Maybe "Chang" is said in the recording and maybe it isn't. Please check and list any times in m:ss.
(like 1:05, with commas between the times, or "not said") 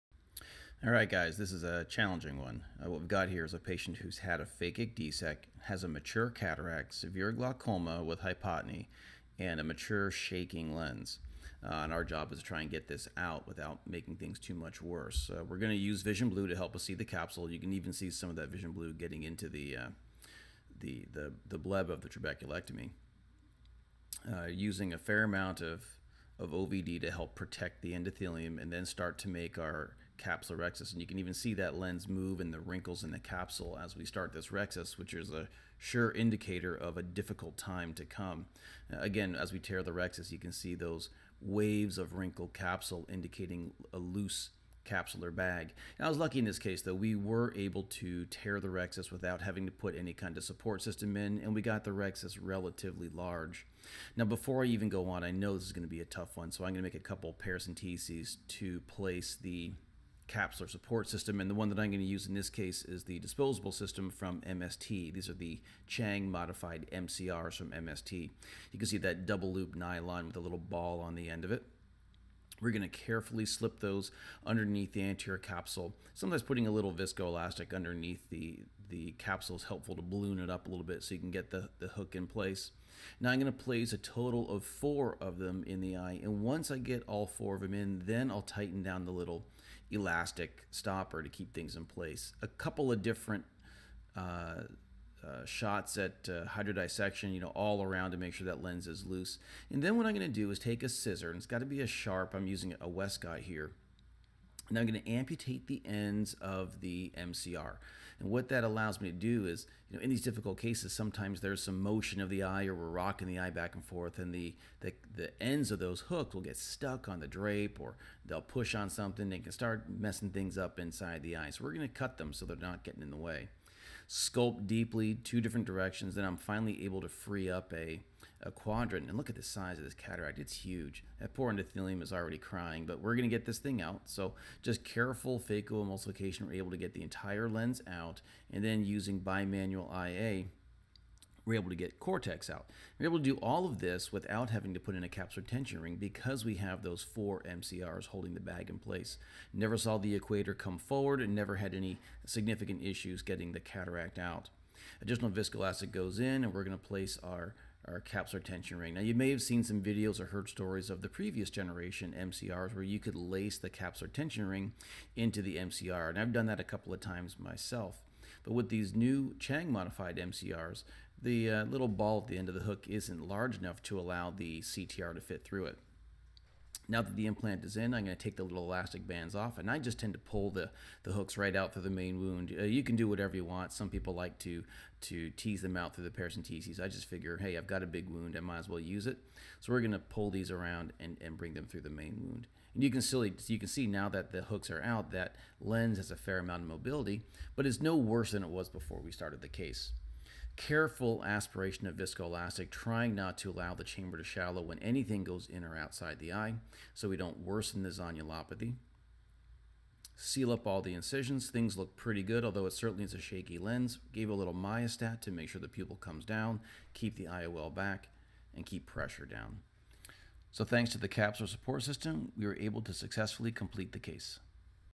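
1:05, 2:49.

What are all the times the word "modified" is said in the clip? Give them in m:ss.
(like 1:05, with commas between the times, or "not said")
1:06, 2:49.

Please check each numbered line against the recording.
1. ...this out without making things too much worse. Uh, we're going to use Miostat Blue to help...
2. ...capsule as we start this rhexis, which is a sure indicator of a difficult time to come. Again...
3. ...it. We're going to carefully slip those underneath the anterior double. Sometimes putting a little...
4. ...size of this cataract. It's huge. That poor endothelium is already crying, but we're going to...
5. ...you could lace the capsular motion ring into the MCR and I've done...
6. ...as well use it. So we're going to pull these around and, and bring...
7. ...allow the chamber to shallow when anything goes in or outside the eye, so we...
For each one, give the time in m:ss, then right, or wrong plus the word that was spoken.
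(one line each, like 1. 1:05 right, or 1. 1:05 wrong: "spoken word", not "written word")
1. 0:12 wrong: "Vision", not "Miostat"
2. 0:33 right
3. 1:11 wrong: "capsule", not "double"
4. 2:09 right
5. 2:42 wrong: "tension", not "motion"
6. 3:08 right
7. 3:23 right.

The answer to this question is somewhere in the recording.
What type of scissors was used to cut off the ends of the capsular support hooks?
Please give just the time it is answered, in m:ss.
1:42.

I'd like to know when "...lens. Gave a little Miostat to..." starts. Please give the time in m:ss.
3:33.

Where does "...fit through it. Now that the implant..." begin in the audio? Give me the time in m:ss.
2:55.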